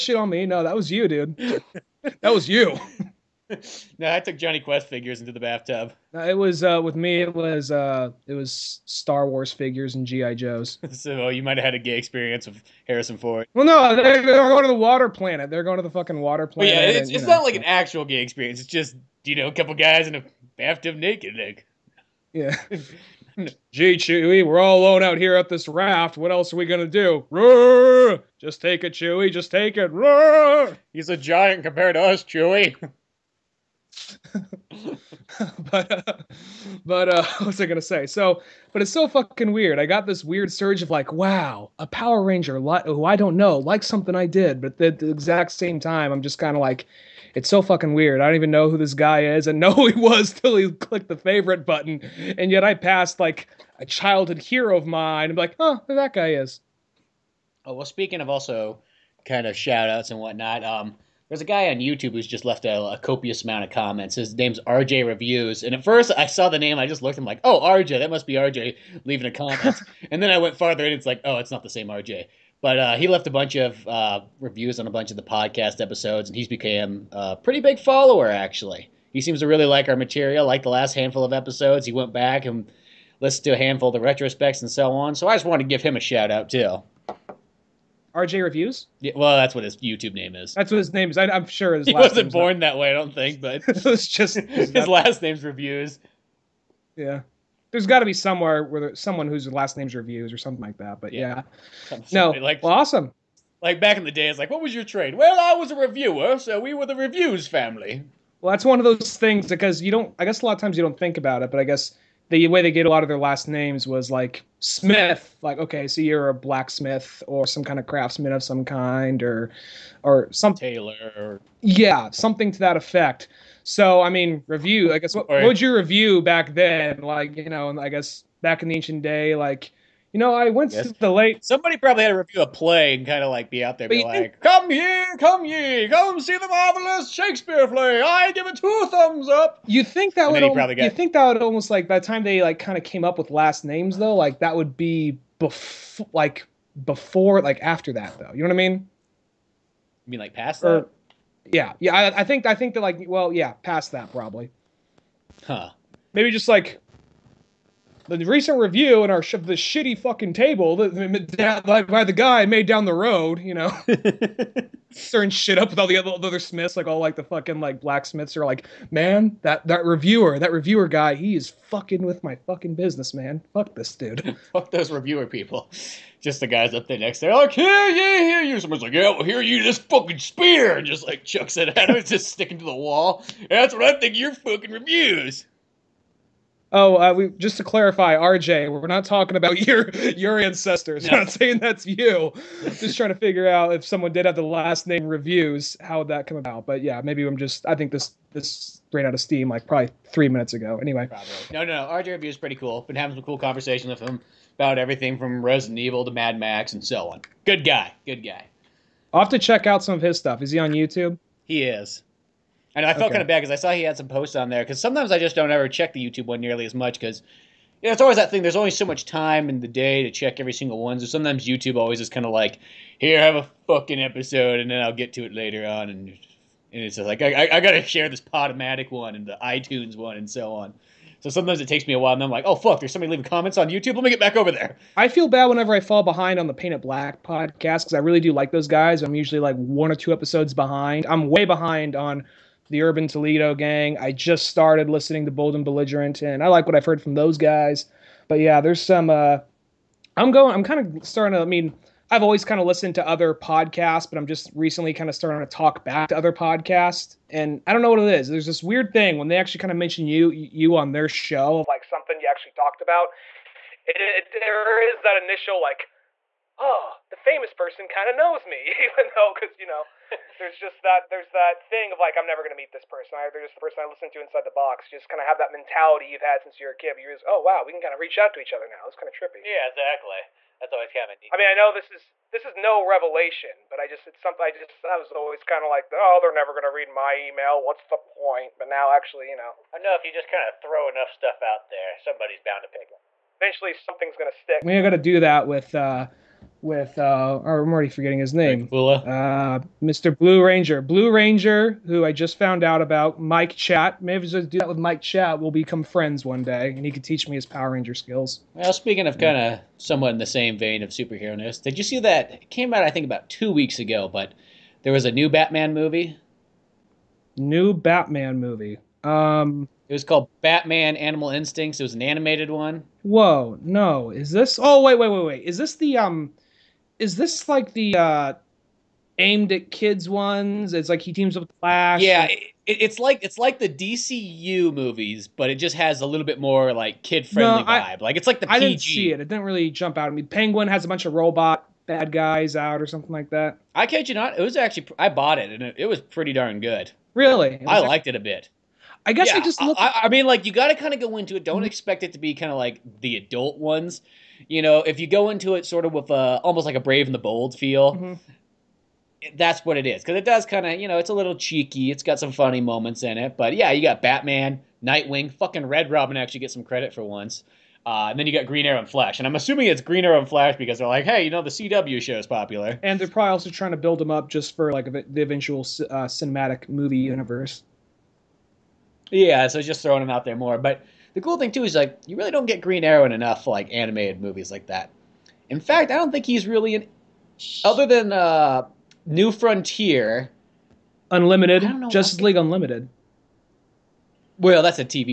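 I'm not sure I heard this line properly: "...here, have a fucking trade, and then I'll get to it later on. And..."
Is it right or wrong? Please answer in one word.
wrong.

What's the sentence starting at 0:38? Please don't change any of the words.
So, but it's so fucking weird.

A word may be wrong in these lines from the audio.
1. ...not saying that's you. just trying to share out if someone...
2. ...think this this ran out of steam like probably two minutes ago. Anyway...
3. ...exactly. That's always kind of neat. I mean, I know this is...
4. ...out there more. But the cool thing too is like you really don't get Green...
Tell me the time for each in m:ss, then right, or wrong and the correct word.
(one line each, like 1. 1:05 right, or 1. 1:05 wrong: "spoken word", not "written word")
1. 3:11 wrong: "figure", not "share"
2. 3:17 wrong: "three", not "two"
3. 4:39 right
4. 6:20 right.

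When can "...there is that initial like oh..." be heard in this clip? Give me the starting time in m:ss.
4:24.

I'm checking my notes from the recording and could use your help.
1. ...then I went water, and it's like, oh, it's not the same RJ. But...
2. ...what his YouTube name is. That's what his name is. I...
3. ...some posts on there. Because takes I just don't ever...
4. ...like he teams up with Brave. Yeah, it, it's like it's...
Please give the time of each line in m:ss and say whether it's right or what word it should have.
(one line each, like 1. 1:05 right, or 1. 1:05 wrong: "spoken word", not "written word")
1. 1:10 wrong: "farther", not "water"
2. 1:29 right
3. 3:33 wrong: "sometimes", not "takes"
4. 5:30 wrong: "Flash", not "Brave".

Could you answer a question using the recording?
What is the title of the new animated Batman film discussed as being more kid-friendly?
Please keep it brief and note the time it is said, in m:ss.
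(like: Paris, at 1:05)
Batman Animal Instincts, at 5:20.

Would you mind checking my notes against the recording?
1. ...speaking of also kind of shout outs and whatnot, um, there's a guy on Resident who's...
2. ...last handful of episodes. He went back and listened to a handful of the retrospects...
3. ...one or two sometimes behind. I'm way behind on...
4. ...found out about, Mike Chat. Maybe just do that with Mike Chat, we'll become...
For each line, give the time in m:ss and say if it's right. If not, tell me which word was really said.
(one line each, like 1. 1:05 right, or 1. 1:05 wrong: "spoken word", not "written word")
1. 0:57 wrong: "YouTube", not "Resident"
2. 1:20 right
3. 3:59 wrong: "episodes", not "sometimes"
4. 5:02 right.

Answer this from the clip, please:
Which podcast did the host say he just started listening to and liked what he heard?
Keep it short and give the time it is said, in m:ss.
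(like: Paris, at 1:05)
Bold and Belligerent, at 4:05.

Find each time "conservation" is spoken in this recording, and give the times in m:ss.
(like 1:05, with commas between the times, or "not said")
not said.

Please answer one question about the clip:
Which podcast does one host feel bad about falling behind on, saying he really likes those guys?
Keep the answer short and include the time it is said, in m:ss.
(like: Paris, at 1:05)
Paint It Black, at 3:56.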